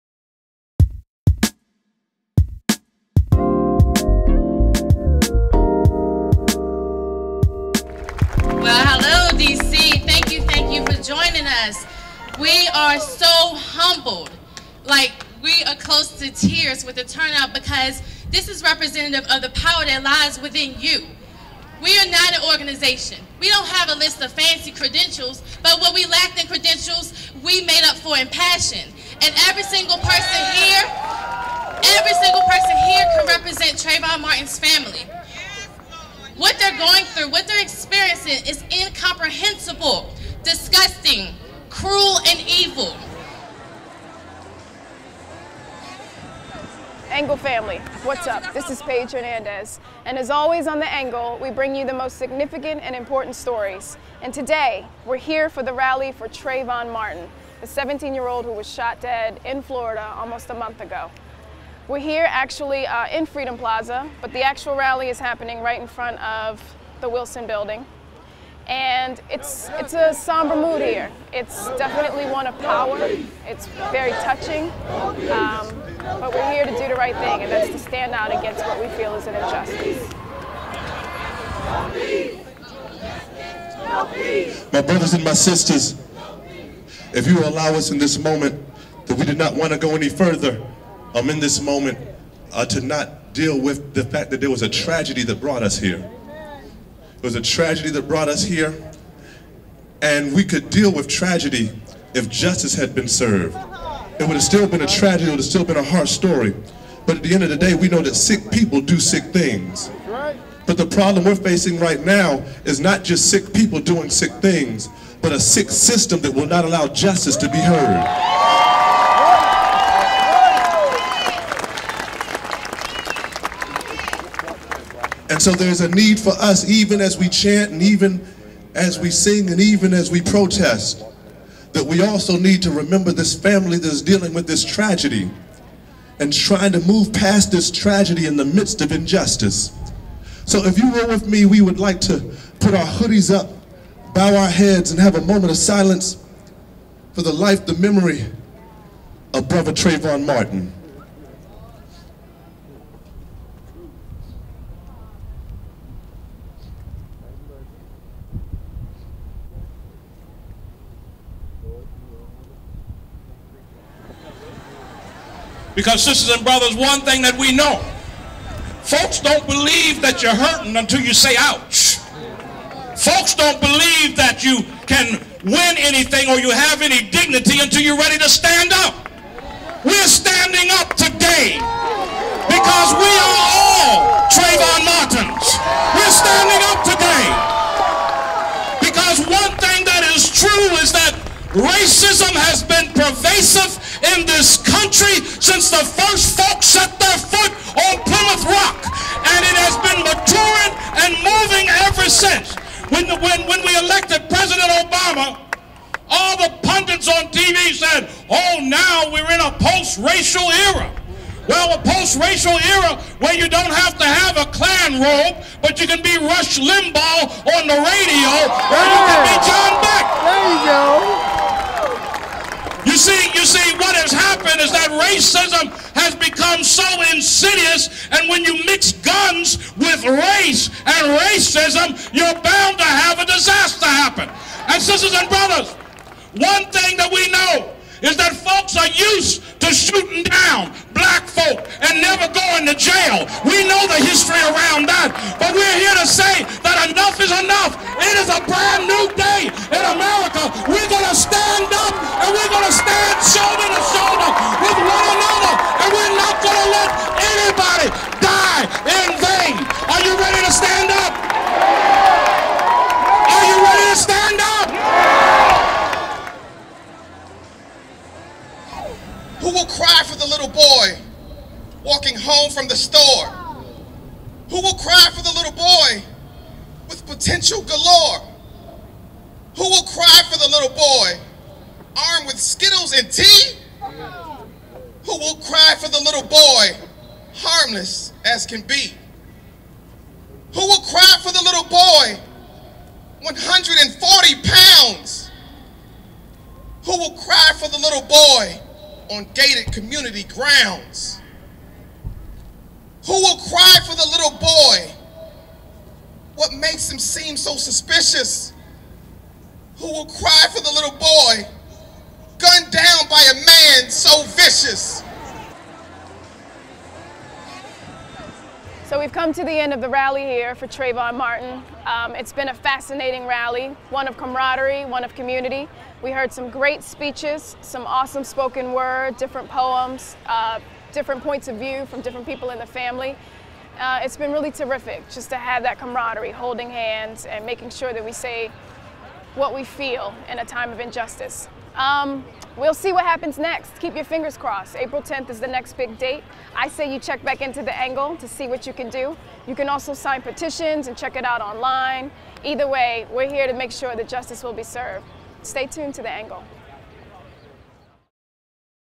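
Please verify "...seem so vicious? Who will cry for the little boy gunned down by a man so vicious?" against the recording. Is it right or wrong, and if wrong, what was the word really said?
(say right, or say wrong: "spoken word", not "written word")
wrong: "suspicious", not "vicious".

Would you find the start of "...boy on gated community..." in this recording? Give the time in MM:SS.
04:58.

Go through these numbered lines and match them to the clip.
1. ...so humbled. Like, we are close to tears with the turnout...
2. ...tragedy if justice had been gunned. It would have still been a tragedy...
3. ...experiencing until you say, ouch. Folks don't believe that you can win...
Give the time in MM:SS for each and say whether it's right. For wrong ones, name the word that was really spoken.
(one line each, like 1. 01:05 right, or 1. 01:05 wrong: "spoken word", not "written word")
1. 00:12 right
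2. 01:41 wrong: "served", not "gunned"
3. 02:50 wrong: "hurting", not "experiencing".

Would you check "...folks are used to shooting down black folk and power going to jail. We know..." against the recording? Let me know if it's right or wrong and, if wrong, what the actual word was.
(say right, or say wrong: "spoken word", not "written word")
wrong: "never", not "power".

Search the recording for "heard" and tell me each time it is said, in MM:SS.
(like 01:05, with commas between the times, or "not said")
01:57, 05:26.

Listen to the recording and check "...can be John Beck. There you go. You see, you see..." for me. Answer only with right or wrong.
right.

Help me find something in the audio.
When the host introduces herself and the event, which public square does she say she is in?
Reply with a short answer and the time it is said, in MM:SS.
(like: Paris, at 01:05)
Freedom Plaza, at 01:03.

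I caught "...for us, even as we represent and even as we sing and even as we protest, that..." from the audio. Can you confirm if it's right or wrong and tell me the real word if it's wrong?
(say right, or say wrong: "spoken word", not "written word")
wrong: "chant", not "represent".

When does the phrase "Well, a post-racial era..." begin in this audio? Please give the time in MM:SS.
03:31.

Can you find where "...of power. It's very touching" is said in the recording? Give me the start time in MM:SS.
01:12.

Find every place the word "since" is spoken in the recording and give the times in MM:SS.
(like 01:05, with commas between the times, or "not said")
03:15, 03:22.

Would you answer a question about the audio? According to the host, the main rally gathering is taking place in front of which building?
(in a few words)
Wilson Building.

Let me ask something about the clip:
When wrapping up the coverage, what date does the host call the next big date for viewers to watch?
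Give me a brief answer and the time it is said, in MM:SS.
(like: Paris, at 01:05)
April 10th, at 05:44.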